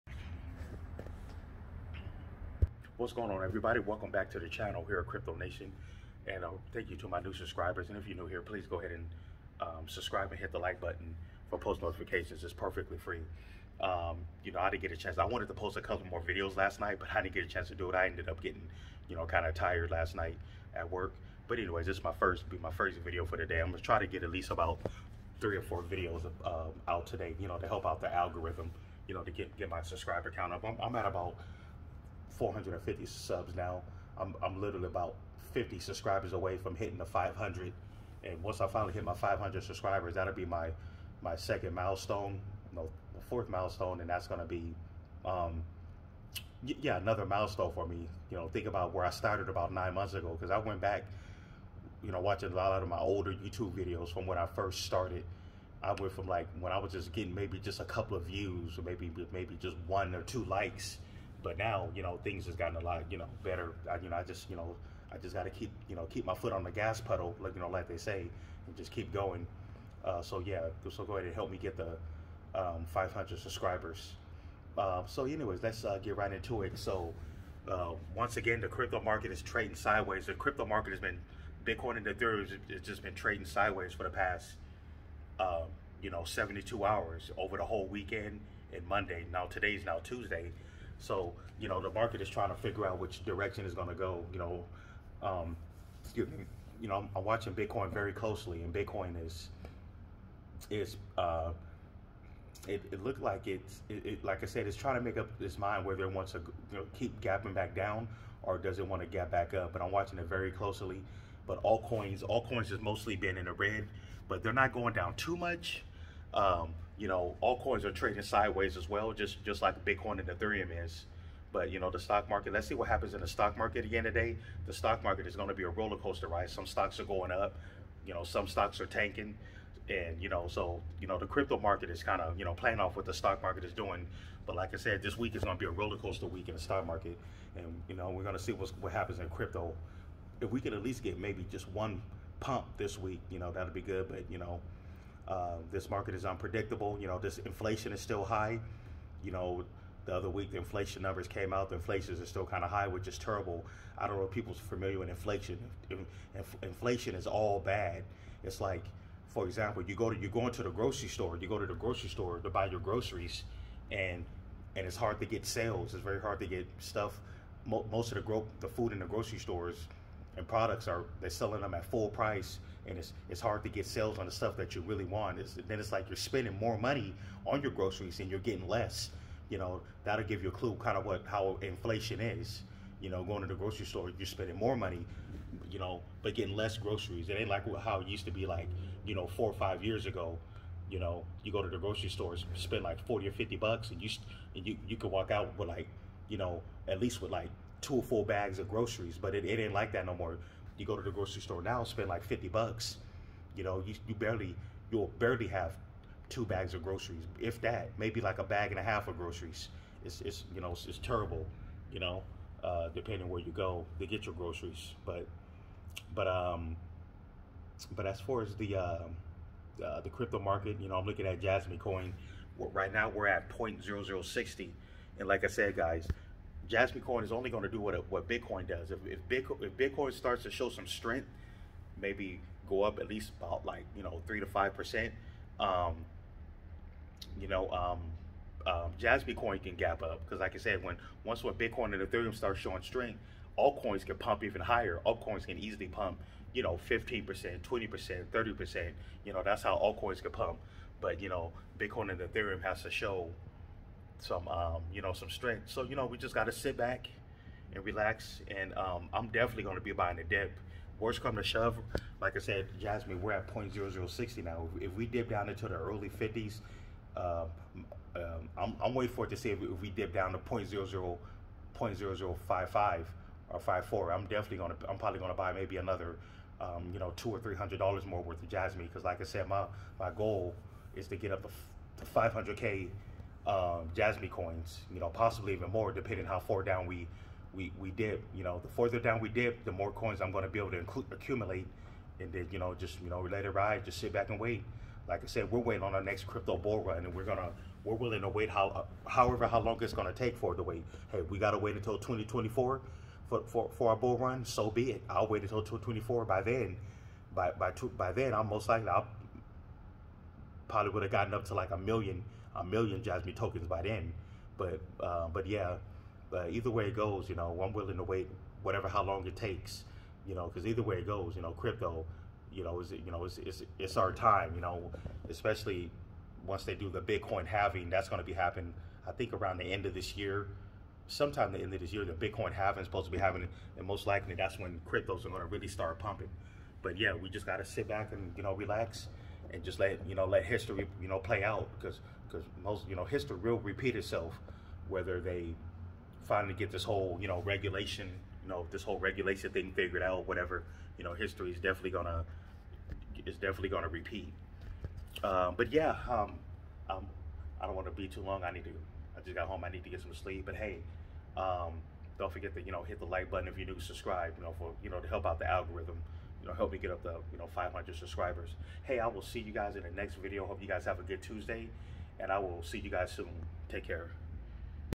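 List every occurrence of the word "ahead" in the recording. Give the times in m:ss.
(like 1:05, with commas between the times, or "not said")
0:08, 1:11.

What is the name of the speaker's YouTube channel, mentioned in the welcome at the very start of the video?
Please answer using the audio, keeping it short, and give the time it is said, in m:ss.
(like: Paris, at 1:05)
Crypto Nation, at 0:05.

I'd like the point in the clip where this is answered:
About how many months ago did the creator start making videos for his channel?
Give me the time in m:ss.
0:49.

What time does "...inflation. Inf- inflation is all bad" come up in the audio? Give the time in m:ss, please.
2:35.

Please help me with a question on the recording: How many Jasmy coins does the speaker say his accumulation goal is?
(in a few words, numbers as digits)
500k.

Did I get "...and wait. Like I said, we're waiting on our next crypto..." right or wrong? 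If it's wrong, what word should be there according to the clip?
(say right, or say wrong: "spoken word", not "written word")
right.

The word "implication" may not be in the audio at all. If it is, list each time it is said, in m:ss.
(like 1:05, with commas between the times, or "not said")
not said.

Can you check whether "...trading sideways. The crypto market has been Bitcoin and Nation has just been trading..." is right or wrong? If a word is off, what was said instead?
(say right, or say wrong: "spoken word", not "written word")
wrong: "Ethereum", not "Nation".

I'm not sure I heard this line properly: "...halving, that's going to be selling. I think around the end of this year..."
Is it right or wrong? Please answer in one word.
wrong.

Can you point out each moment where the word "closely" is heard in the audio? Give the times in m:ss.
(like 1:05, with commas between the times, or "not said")
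1:38, 1:50.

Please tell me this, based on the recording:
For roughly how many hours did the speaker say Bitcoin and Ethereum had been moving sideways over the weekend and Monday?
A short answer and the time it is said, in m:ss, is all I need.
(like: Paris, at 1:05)
72, at 1:26.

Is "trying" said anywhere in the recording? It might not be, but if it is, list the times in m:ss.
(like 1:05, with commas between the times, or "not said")
1:32, 1:44.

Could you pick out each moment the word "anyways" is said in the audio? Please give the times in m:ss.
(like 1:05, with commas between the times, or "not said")
0:21, 1:15.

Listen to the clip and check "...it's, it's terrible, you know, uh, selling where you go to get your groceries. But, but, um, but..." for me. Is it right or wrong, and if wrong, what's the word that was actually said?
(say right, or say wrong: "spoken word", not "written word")
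wrong: "depending", not "selling".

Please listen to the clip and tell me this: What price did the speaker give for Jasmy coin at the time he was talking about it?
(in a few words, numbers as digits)
0.0060.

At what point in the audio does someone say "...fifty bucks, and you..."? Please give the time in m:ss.
3:13.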